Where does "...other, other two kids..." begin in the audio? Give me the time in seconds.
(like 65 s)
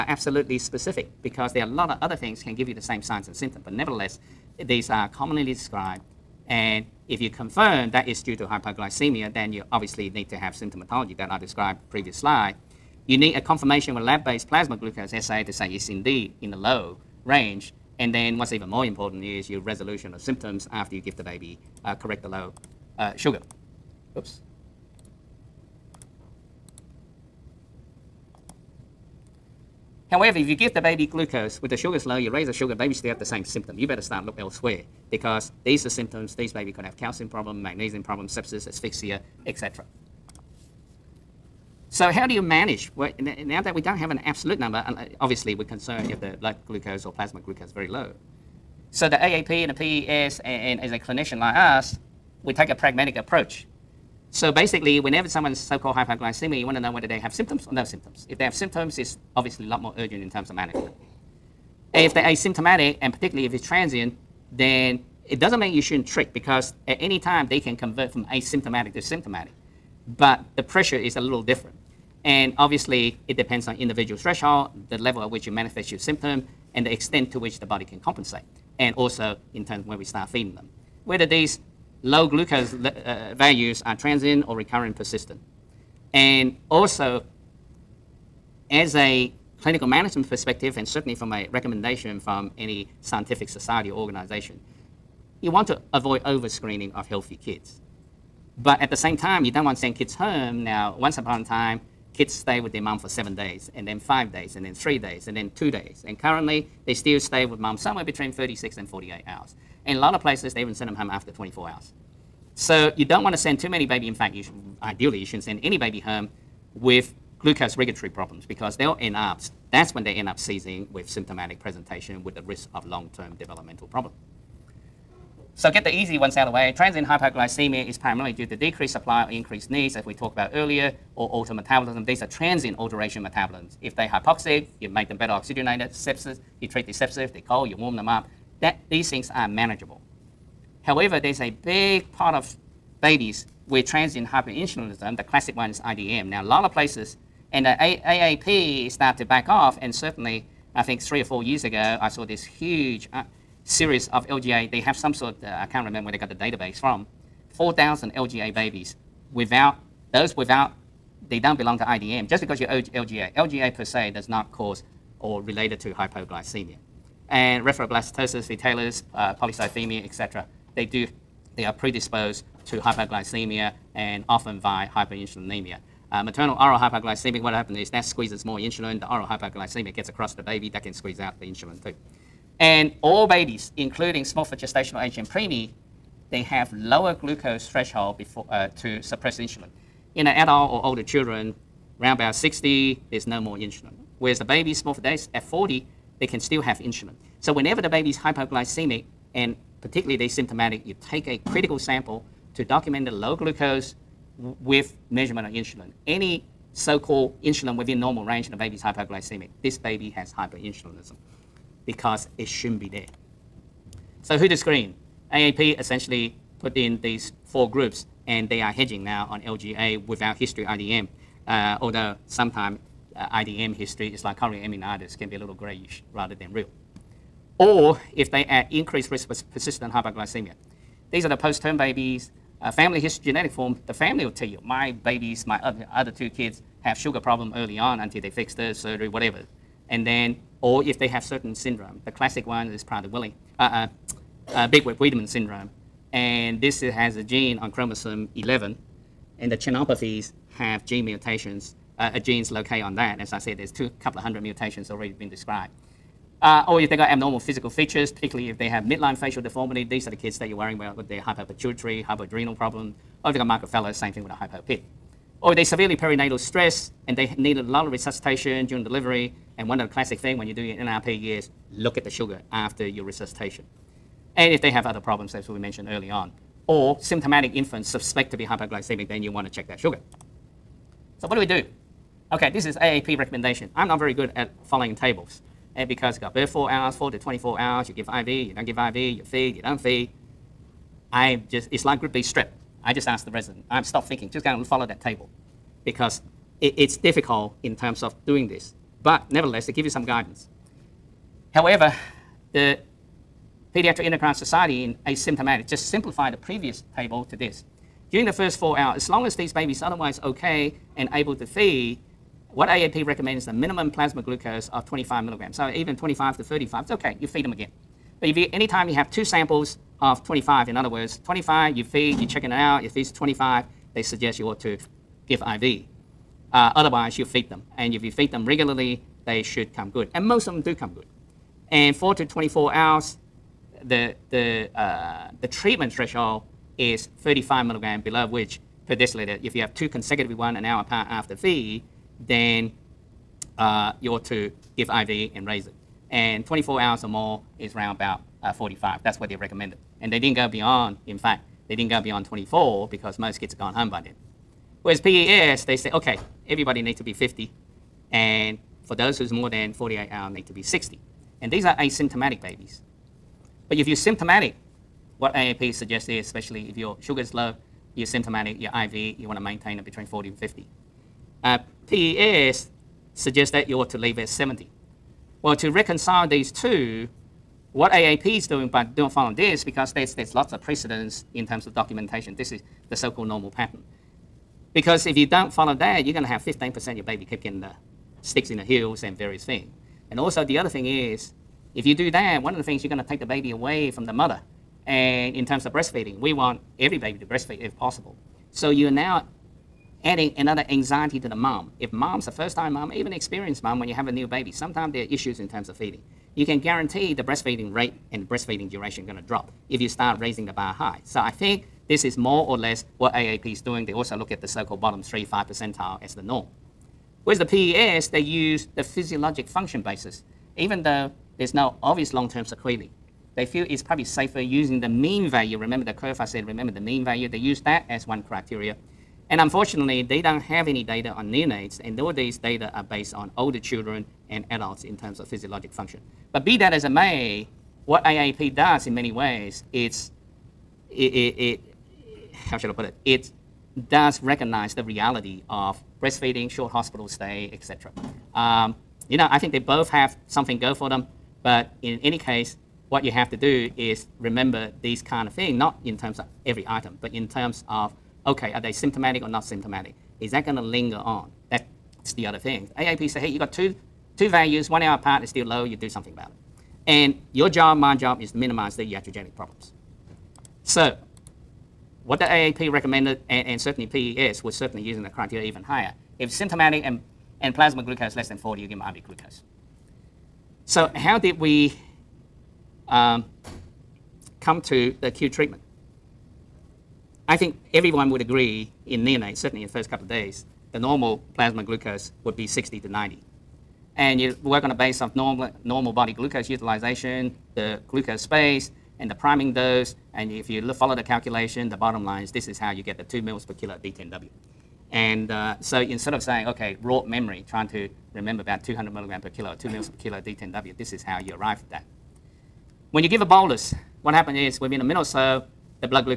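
235 s.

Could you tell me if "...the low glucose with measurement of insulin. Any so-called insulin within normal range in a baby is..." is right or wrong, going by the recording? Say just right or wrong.
right.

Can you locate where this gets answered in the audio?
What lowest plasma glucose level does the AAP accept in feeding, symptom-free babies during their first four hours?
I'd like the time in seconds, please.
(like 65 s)
314 s.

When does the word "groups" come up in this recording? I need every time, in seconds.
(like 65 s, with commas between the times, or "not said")
217 s, 291 s.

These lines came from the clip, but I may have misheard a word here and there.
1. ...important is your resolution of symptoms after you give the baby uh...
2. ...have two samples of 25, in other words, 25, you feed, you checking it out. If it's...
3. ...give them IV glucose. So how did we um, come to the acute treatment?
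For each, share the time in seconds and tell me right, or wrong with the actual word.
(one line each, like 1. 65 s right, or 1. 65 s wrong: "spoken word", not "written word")
1. 18 s right
2. 318 s right
3. 478 s right.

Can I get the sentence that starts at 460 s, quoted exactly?
Is that going to linger on?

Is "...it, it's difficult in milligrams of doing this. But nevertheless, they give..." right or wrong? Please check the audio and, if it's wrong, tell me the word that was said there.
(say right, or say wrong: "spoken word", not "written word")
wrong: "terms", not "milligrams".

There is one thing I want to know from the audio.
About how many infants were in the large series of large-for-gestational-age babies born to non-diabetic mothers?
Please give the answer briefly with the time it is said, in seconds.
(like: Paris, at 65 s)
4,000, at 157 s.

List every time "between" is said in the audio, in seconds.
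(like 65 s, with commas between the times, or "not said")
108 s, 369 s.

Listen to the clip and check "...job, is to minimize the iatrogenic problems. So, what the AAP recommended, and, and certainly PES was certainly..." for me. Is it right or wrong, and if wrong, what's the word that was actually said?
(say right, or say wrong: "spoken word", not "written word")
right.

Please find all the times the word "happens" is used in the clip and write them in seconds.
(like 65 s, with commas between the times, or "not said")
177 s, 514 s.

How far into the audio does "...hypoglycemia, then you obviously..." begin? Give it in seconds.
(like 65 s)
8 s.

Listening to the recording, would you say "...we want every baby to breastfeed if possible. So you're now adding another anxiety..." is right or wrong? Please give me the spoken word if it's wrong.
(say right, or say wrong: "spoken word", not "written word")
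right.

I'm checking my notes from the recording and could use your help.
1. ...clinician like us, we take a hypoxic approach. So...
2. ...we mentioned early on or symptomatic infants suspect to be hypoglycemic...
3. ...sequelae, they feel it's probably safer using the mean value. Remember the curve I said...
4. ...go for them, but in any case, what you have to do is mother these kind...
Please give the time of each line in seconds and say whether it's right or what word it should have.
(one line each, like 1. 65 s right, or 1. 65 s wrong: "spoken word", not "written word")
1. 50 s wrong: "pragmatic", not "hypoxic"
2. 275 s right
3. 422 s right
4. 450 s wrong: "remember", not "mother".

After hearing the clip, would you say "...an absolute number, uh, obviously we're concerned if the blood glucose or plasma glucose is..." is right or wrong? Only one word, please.
right.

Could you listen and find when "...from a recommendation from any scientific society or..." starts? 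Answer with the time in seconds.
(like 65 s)
91 s.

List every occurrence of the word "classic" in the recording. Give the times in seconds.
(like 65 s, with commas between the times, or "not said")
145 s, 242 s, 269 s.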